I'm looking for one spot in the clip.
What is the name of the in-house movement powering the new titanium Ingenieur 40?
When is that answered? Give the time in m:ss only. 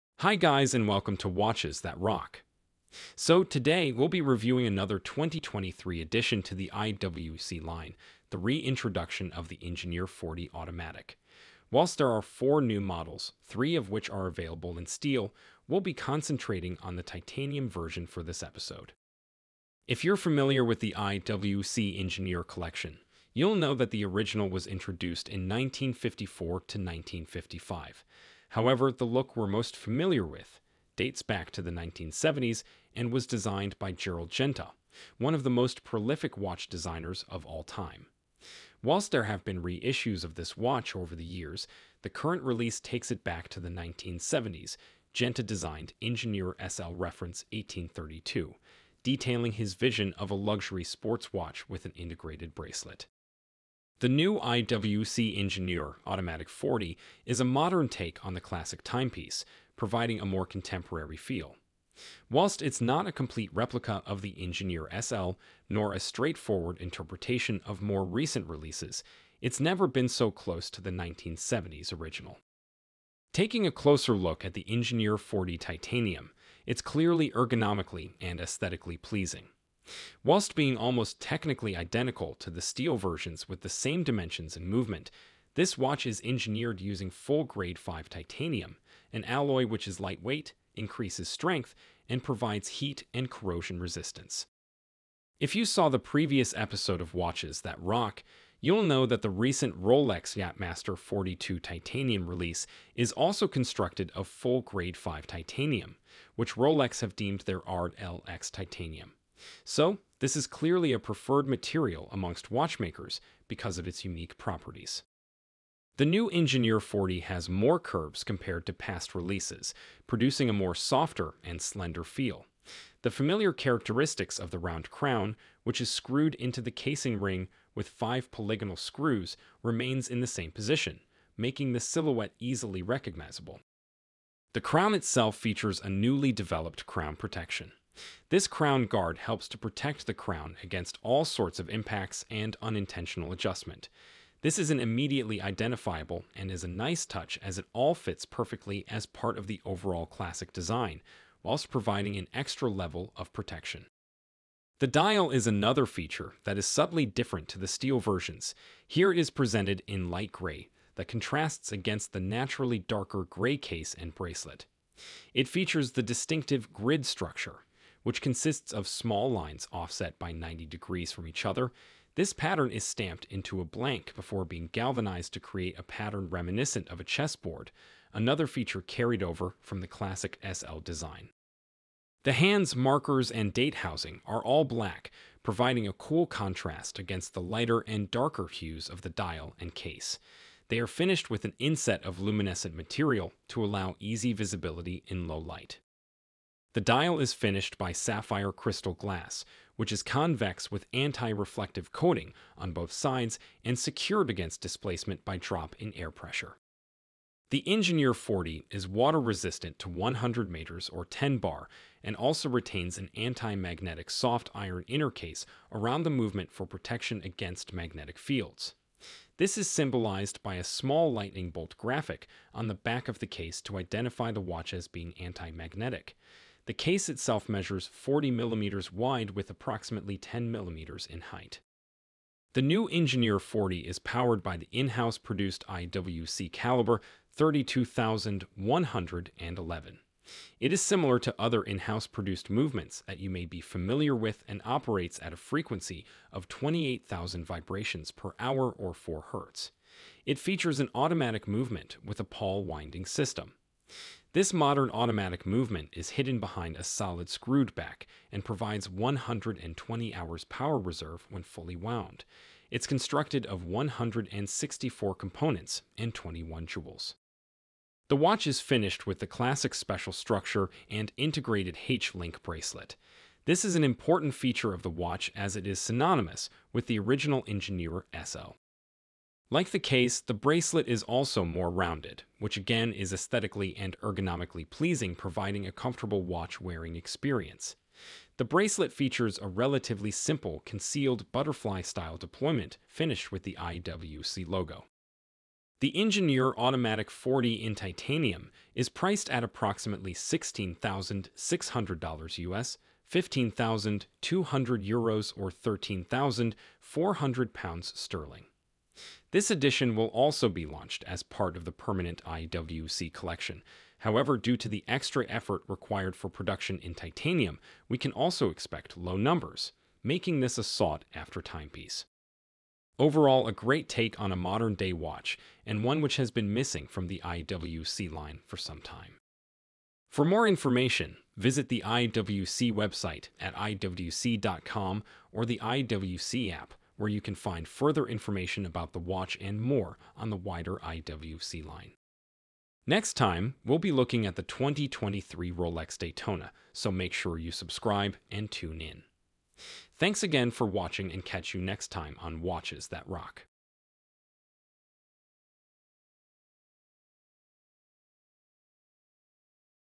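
3:56.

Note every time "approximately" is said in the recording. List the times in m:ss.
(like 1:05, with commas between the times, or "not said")
3:49, 4:59.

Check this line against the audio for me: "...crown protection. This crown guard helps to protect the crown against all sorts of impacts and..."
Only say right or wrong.
right.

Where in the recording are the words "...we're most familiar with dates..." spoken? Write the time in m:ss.
0:29.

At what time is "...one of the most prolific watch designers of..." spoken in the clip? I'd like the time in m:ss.
0:35.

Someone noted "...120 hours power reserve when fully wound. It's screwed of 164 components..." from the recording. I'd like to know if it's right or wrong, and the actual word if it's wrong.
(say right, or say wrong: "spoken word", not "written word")
wrong: "constructed", not "screwed".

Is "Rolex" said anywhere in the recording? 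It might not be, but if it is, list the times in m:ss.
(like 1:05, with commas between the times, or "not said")
1:39, 1:46, 5:45.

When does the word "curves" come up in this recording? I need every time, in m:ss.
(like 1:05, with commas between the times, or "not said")
1:57.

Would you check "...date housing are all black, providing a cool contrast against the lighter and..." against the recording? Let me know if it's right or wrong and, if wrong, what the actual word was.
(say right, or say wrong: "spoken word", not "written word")
right.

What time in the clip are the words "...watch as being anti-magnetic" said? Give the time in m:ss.
3:44.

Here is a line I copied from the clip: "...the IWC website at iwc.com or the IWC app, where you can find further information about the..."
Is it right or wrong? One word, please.
right.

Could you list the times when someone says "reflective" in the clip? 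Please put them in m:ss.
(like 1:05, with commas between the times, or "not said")
3:20.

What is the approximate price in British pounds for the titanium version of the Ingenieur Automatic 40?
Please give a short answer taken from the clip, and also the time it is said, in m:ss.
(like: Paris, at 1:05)
13,400 pounds, at 5:05.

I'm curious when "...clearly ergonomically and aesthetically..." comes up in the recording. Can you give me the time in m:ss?
1:16.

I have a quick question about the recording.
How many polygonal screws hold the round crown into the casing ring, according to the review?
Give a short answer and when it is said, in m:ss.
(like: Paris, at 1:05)
5, at 2:07.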